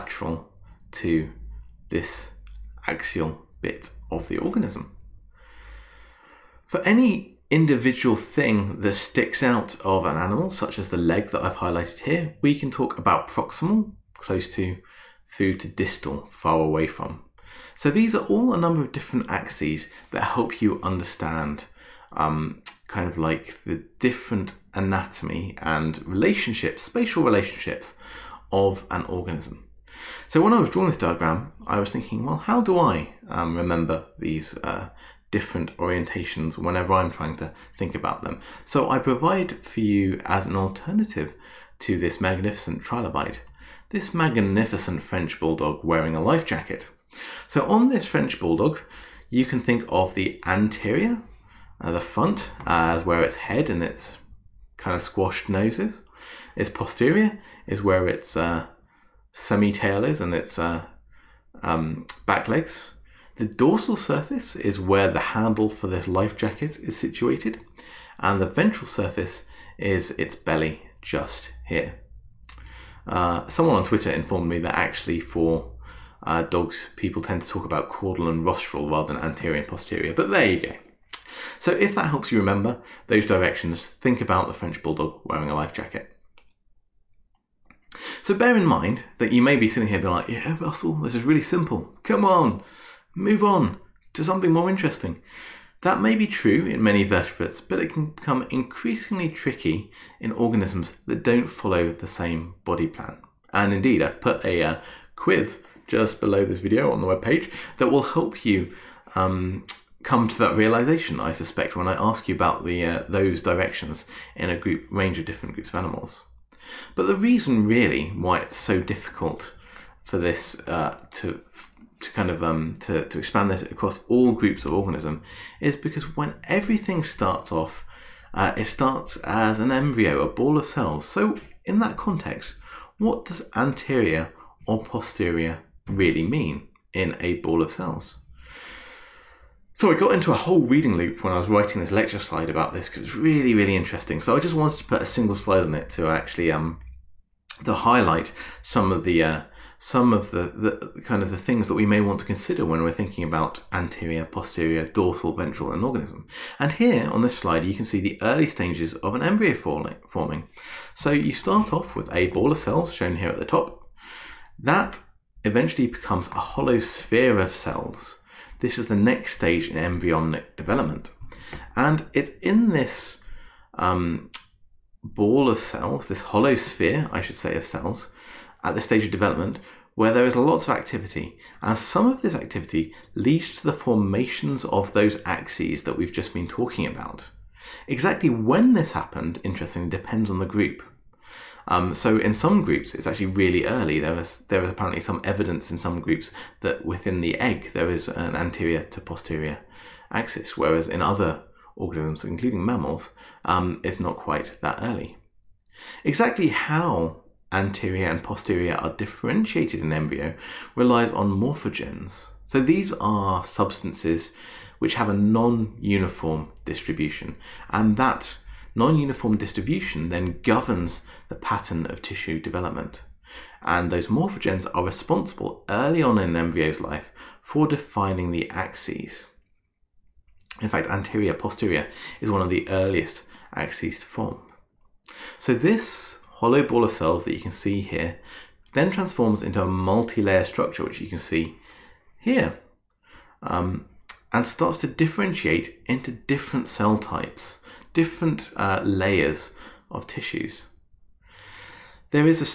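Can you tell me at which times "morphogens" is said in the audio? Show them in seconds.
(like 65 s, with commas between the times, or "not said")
211 s, 224 s.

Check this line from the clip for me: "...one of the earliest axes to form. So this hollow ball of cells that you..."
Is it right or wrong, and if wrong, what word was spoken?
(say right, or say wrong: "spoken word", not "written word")
right.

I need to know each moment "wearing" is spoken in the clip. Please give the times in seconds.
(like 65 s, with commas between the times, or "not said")
45 s, 85 s.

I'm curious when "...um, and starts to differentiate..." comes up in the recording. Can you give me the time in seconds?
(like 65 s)
243 s.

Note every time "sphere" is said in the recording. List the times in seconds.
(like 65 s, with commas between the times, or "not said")
166 s, 176 s.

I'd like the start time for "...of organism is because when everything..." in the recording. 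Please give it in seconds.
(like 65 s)
124 s.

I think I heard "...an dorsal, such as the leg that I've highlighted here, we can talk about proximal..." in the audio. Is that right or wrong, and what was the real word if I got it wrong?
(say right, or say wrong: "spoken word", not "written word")
wrong: "animal", not "dorsal".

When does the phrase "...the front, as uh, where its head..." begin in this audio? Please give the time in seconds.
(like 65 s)
51 s.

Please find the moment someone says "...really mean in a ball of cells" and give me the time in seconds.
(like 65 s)
135 s.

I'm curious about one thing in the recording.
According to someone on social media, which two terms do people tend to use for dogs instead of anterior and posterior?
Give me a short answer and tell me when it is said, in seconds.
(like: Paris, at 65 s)
caudal and rostral, at 77 s.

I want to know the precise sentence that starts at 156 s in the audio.
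And here on this slide, you can see the early stages of an embryo forming.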